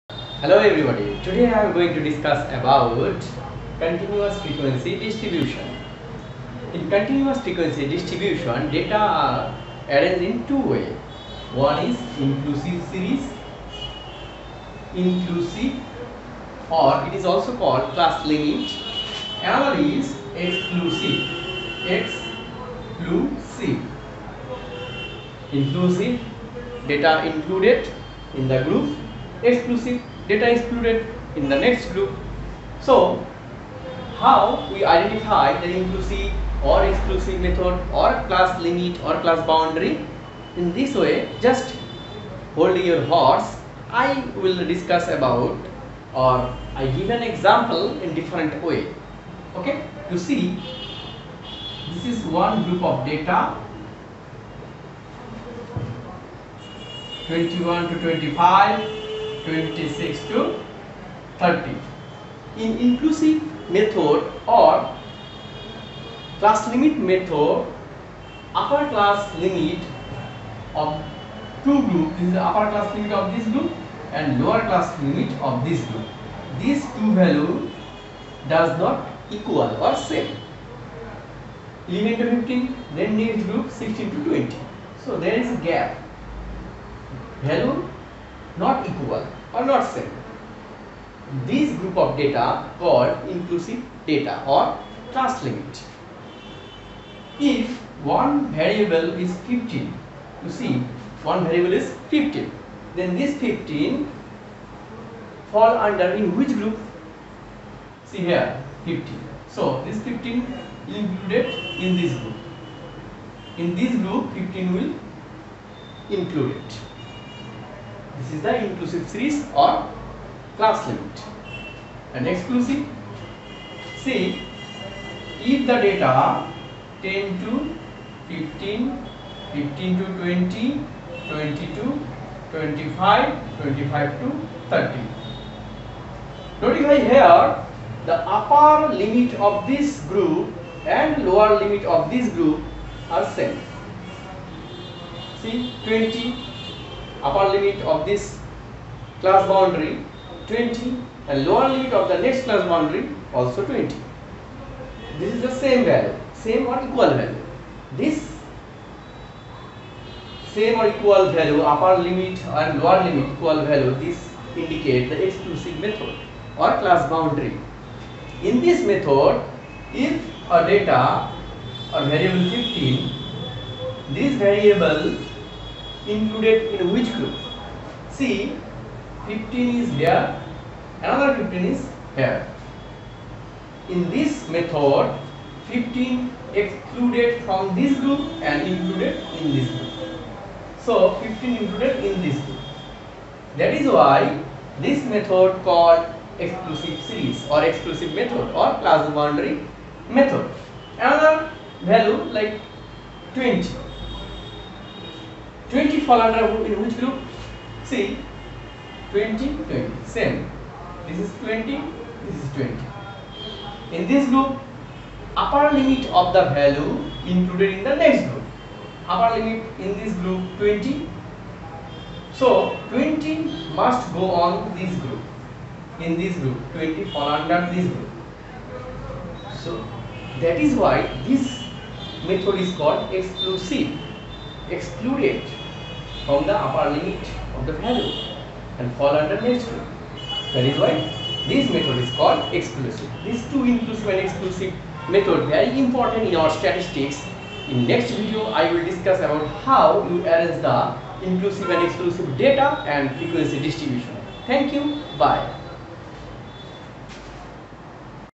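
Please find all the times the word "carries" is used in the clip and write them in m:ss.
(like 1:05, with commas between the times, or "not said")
not said.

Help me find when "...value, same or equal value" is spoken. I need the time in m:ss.
2:35.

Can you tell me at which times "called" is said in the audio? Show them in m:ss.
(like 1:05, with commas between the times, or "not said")
0:17, 1:32, 3:15, 3:52, 4:02.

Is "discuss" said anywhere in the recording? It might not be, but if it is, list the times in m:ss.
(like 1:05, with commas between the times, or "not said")
0:02, 0:44, 4:08.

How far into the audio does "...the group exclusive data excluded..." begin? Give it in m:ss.
0:28.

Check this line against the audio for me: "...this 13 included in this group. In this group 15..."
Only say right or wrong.
wrong.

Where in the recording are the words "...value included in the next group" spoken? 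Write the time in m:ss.
3:36.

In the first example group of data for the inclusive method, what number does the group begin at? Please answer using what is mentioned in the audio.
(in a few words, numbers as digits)
21.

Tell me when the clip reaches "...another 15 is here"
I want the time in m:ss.
3:01.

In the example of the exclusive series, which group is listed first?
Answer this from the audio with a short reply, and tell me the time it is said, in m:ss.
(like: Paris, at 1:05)
10 to 15, at 2:07.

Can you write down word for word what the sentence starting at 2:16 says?
Notify here the upper limit of this group and lower limit of this group are same.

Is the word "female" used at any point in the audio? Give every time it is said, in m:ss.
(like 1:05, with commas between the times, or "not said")
not said.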